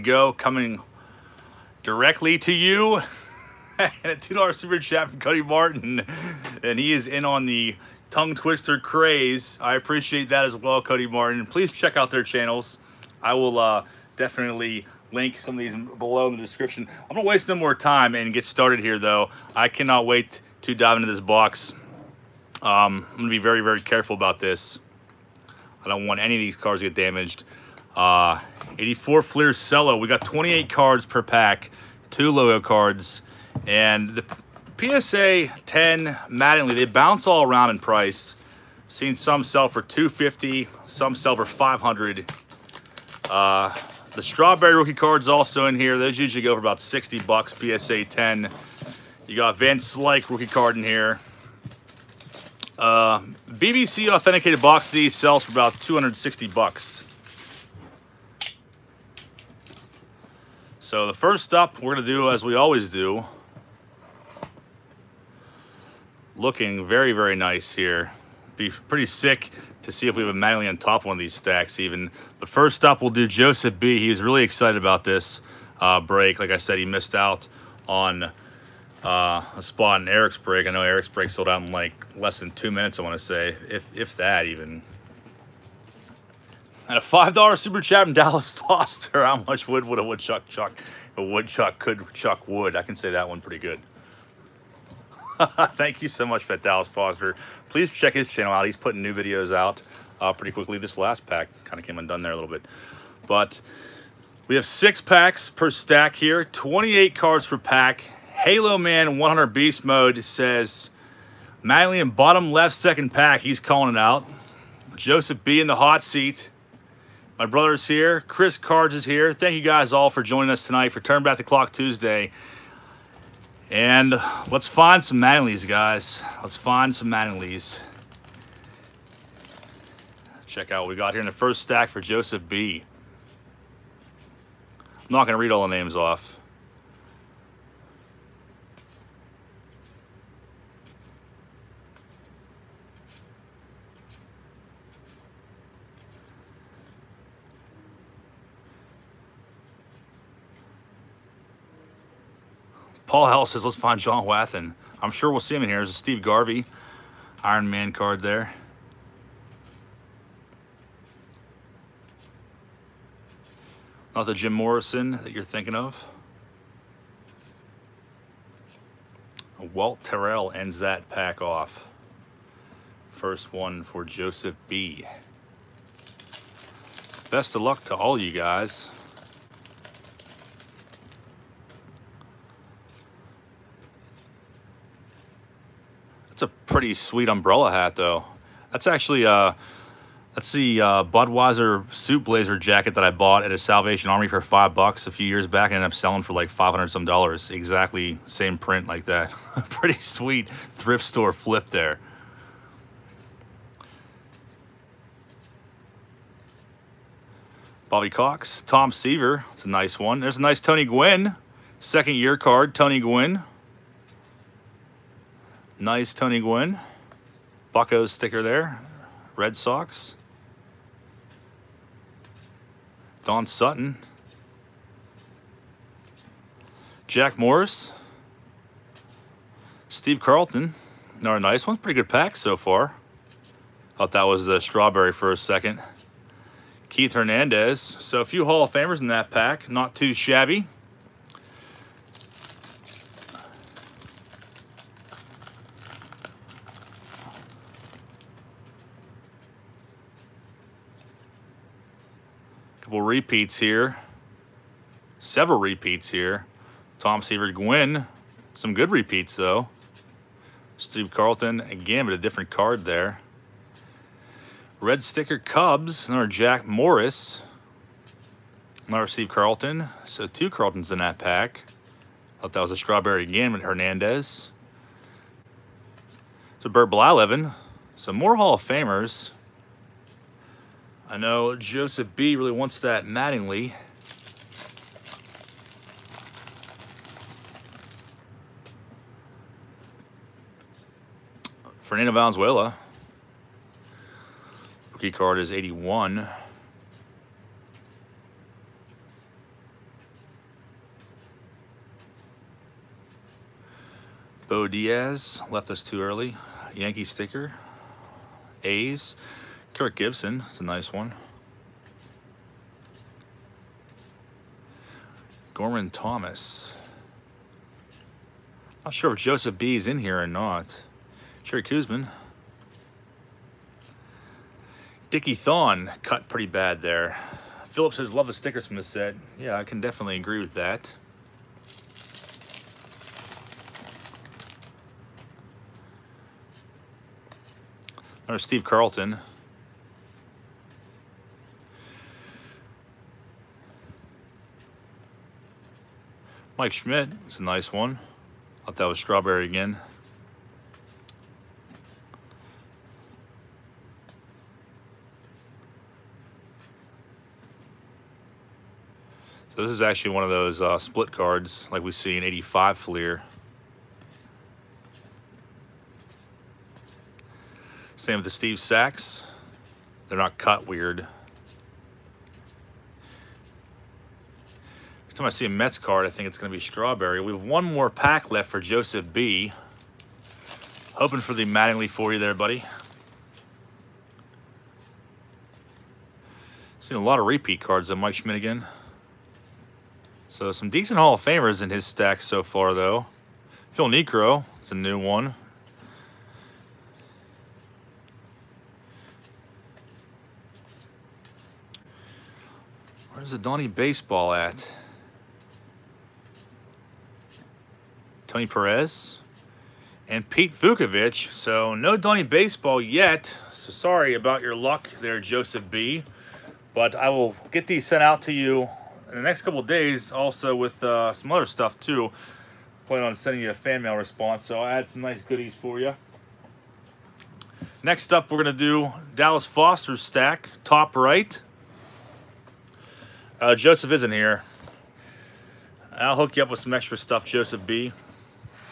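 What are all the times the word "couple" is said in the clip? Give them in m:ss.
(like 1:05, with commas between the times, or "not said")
4:12, 6:59.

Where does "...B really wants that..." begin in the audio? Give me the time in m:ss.
4:42.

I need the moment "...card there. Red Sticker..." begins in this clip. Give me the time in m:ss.
4:22.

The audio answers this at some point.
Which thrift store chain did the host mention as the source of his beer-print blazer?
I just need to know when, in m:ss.
3:13.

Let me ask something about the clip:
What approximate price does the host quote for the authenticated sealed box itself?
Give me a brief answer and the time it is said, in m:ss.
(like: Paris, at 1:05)
$260, at 0:55.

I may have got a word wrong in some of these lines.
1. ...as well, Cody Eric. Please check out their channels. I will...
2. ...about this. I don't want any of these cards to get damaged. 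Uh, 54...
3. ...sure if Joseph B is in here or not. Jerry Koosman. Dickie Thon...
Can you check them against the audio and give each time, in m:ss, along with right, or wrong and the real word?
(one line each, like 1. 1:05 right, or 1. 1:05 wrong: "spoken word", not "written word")
1. 0:10 wrong: "Martin", not "Eric"
2. 0:24 wrong: "84", not "54"
3. 5:18 right.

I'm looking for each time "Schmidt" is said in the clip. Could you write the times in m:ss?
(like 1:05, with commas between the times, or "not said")
5:46, 6:28.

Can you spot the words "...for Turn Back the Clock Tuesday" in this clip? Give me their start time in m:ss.
2:00.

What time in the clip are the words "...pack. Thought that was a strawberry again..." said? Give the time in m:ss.
4:31.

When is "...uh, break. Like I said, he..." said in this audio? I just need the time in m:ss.
1:15.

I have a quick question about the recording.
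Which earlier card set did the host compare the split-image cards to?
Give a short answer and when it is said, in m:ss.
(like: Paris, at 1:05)
85 Fleer, at 6:02.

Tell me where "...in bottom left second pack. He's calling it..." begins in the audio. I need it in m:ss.
1:51.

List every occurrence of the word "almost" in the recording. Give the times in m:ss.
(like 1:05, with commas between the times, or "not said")
not said.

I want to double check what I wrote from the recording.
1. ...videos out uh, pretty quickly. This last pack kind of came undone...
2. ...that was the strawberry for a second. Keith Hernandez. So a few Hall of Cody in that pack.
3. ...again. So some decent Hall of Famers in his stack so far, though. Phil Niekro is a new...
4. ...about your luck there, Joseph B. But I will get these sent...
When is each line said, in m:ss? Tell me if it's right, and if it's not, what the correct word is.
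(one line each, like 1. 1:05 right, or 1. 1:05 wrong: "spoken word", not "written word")
1. 1:39 right
2. 3:54 wrong: "Famers", not "Cody"
3. 6:28 right
4. 6:54 right.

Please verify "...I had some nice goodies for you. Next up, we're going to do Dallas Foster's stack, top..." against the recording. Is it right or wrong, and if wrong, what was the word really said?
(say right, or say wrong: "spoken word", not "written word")
right.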